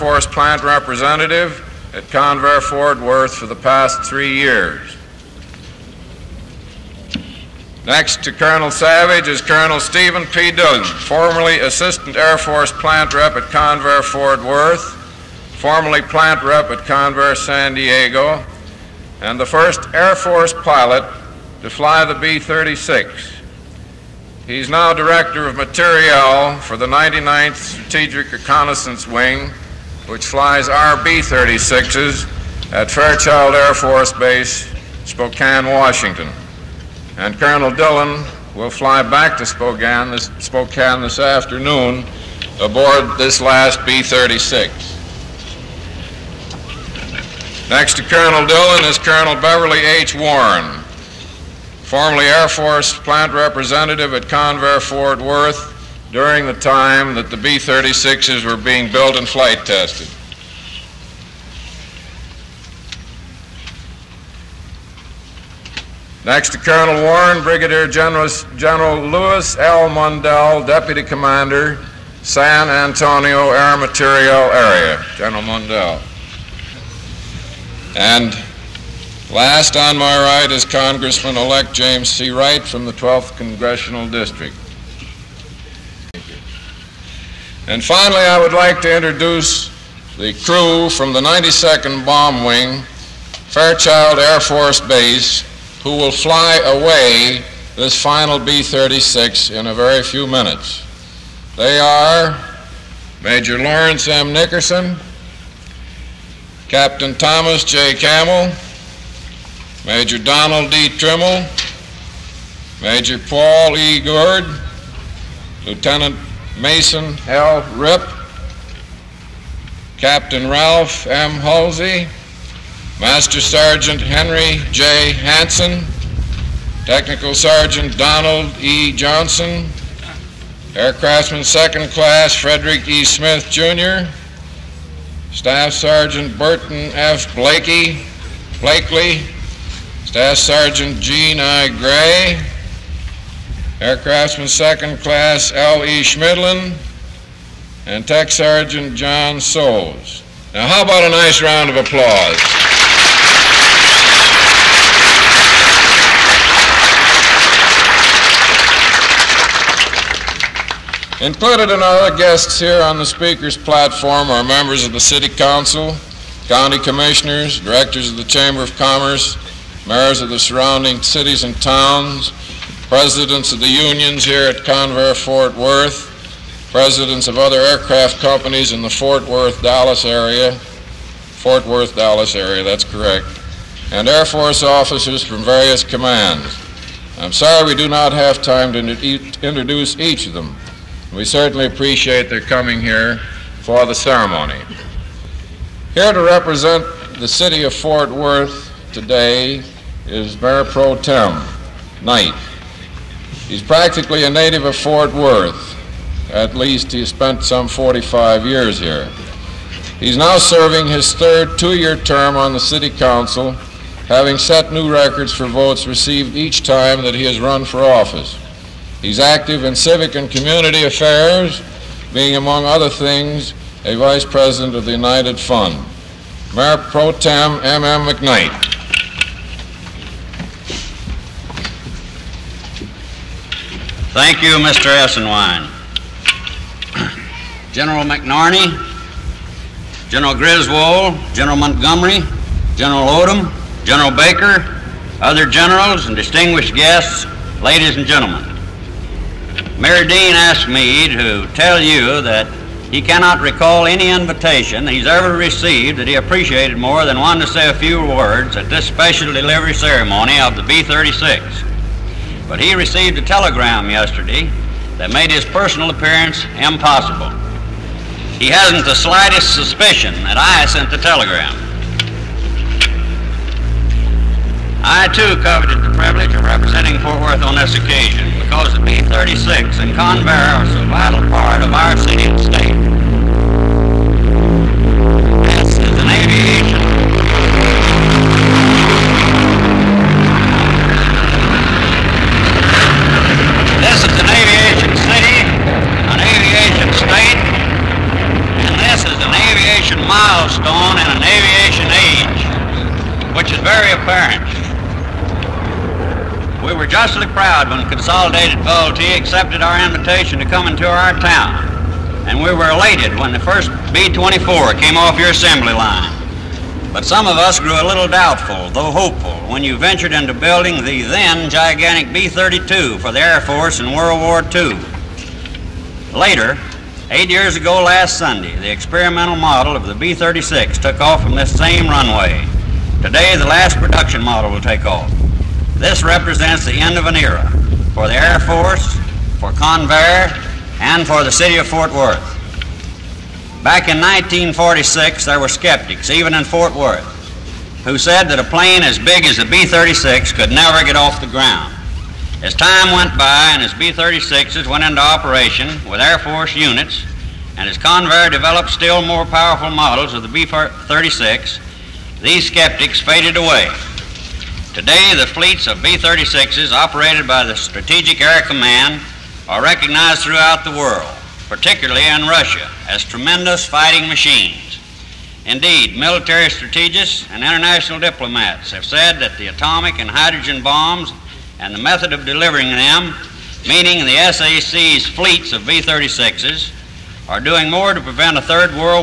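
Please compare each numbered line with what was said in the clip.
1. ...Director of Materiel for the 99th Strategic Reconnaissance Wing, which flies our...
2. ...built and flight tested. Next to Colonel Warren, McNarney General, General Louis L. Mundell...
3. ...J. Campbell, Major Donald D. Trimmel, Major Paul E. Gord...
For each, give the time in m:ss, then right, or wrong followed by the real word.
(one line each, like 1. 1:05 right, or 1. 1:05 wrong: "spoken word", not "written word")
1. 0:24 right
2. 0:58 wrong: "Brigadier", not "McNarney"
3. 1:47 right.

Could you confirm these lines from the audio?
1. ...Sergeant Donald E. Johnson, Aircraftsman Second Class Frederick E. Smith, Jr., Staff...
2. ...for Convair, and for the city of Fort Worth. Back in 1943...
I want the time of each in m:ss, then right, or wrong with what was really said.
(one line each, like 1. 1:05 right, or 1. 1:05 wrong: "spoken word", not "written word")
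1. 2:07 right
2. 5:39 wrong: "1946", not "1943".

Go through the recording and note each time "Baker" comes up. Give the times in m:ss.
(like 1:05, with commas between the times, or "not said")
4:04.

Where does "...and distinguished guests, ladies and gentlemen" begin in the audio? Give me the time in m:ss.
4:06.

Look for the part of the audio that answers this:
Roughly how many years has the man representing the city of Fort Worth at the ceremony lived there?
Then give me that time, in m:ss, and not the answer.
3:27.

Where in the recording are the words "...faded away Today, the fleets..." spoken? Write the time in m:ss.
6:02.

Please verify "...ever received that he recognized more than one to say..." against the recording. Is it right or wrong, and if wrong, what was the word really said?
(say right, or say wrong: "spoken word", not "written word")
wrong: "appreciated", not "recognized".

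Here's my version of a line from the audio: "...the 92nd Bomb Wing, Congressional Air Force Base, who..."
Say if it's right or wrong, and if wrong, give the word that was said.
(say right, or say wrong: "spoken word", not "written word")
wrong: "Fairchild", not "Congressional".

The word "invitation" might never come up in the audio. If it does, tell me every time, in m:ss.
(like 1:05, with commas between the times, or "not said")
4:14, 5:09.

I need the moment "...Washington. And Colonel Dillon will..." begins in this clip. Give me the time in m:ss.
0:35.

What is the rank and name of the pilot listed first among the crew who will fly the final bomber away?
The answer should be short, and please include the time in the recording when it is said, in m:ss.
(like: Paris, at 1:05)
Major Lawrence M. Nickerson, at 1:43.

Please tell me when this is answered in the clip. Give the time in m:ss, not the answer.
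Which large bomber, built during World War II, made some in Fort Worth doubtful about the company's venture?
5:22.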